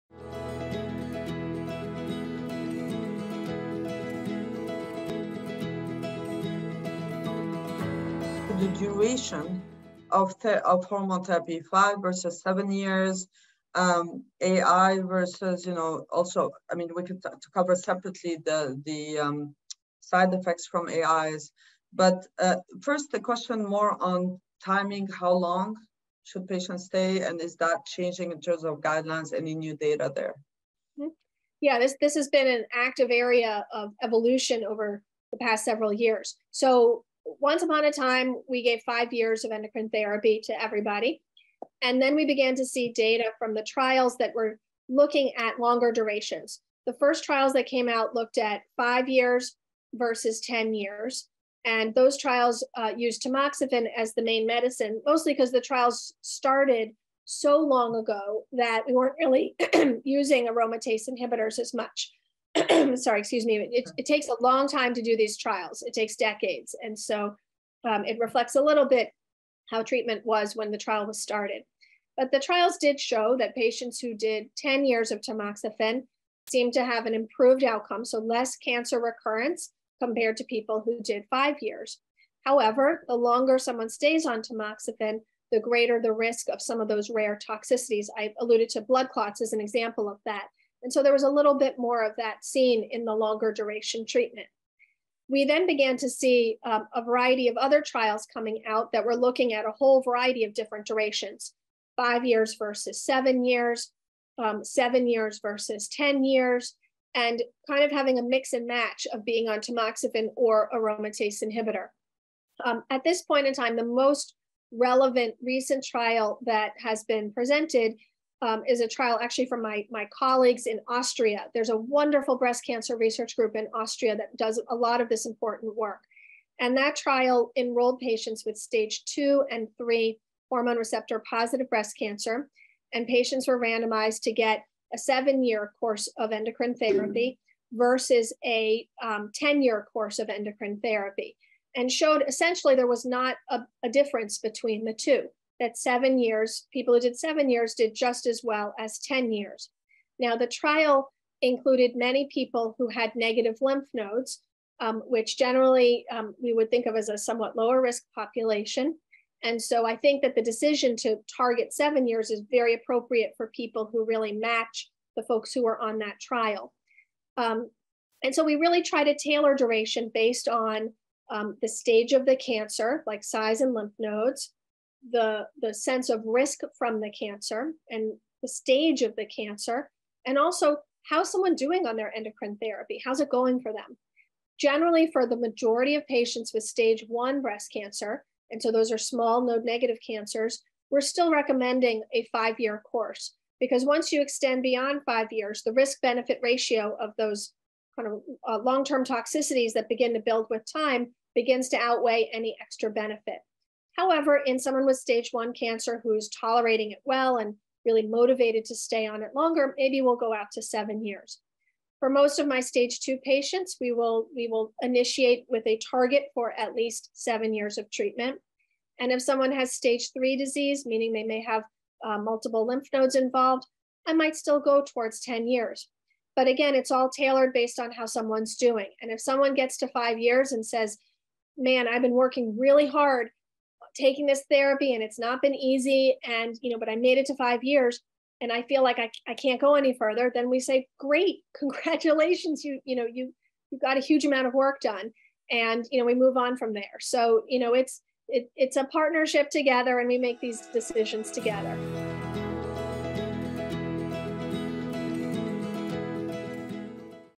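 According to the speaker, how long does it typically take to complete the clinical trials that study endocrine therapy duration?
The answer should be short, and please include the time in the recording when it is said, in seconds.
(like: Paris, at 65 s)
Decades, at 66 s.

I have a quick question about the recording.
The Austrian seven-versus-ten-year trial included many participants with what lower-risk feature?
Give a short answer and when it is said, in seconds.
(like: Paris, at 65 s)
Negative lymph nodes, at 153 s.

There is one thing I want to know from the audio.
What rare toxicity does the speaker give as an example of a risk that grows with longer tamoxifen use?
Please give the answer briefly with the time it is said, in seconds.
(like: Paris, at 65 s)
Blood clots, at 88 s.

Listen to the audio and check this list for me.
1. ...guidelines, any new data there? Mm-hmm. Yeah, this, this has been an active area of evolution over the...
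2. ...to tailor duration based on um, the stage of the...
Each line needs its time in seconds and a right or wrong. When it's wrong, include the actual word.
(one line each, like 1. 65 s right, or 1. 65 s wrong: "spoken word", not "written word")
1. 28 s right
2. 169 s right.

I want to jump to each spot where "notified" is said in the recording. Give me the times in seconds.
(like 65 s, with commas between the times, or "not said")
not said.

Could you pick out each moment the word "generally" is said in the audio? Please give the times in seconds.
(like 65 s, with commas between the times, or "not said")
155 s, 184 s.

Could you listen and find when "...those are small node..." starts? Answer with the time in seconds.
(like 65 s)
188 s.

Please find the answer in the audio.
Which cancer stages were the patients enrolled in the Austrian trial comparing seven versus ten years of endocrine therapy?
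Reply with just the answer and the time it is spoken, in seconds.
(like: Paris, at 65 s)
Stages 2 and 3, at 129 s.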